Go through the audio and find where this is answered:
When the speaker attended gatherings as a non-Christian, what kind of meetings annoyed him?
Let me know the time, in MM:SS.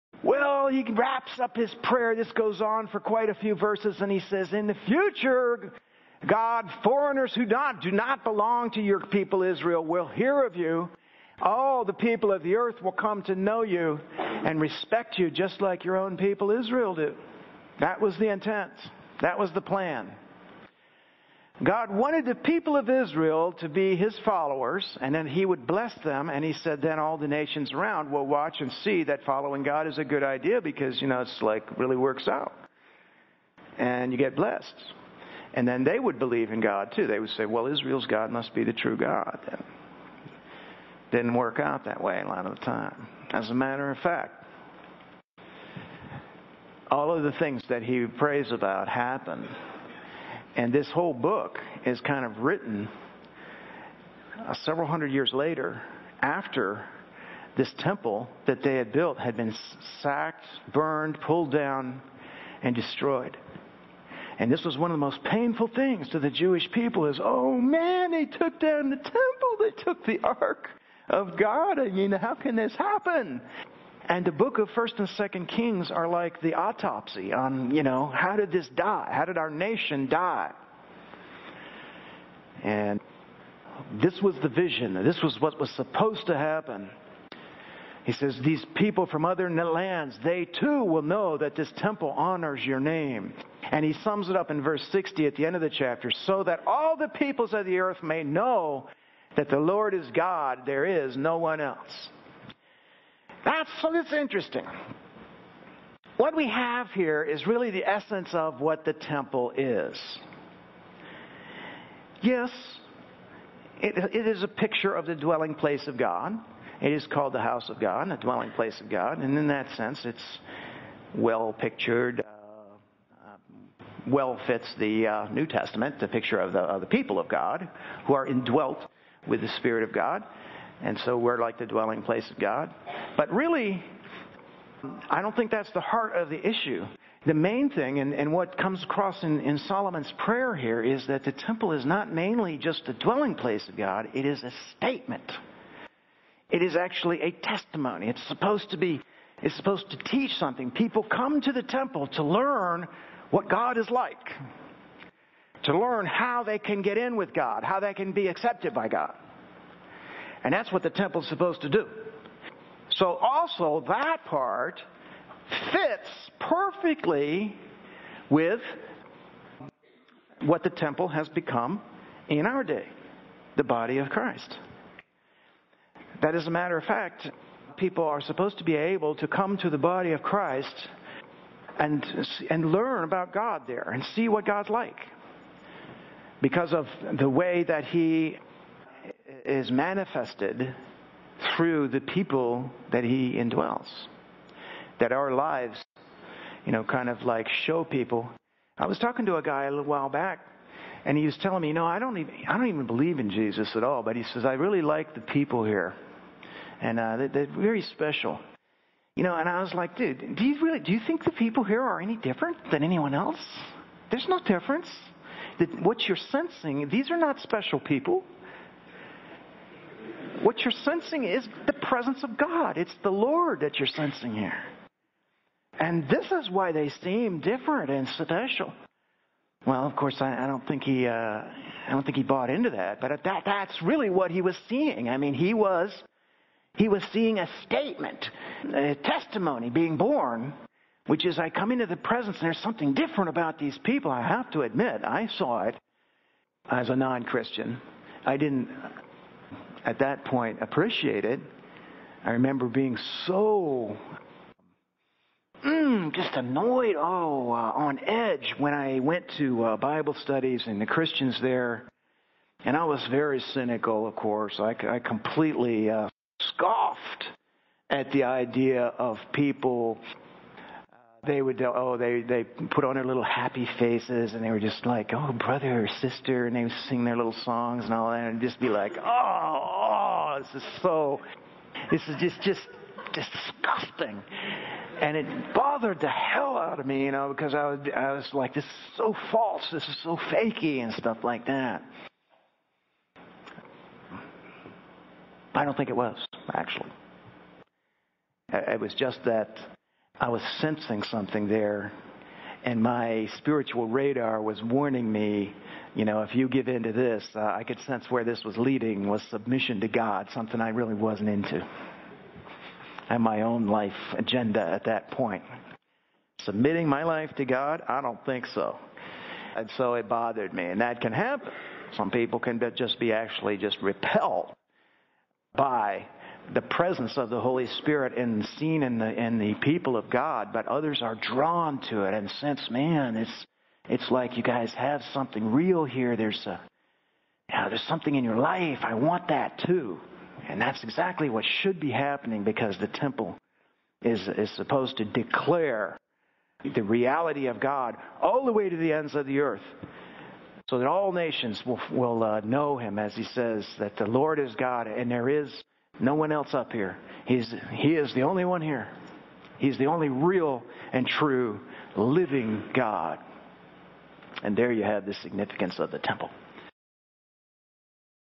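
04:19.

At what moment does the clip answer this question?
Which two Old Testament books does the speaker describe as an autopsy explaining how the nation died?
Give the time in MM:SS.
01:14.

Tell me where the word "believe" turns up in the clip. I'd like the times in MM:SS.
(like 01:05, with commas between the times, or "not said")
00:36, 03:22.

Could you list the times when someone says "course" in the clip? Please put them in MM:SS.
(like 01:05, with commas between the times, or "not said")
03:49, 04:24.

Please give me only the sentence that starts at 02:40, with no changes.
And that's what the temple is supposed to do.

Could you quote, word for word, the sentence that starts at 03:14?
That our lives, you know, kind of like show people.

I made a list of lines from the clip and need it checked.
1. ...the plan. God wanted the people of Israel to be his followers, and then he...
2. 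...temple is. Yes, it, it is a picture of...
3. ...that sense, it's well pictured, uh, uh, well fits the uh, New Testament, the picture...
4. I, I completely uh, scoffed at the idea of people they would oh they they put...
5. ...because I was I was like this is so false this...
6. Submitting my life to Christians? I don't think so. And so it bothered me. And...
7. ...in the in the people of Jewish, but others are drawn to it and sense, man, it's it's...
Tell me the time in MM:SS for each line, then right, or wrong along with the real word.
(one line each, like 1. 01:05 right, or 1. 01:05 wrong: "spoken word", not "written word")
1. 00:19 right
2. 01:48 right
3. 01:59 right
4. 04:24 right
5. 04:47 right
6. 05:16 wrong: "God", not "Christians"
7. 05:28 wrong: "God", not "Jewish".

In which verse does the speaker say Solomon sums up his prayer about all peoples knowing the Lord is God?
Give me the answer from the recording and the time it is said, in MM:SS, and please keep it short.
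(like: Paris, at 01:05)
Verse 60, at 01:34.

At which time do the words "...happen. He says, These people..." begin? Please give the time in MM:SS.
01:26.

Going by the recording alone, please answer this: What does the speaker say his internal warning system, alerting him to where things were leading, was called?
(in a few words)
spiritual radar.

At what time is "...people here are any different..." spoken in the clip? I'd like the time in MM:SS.
03:31.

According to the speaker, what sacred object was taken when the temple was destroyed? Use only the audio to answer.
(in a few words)
the ark of God.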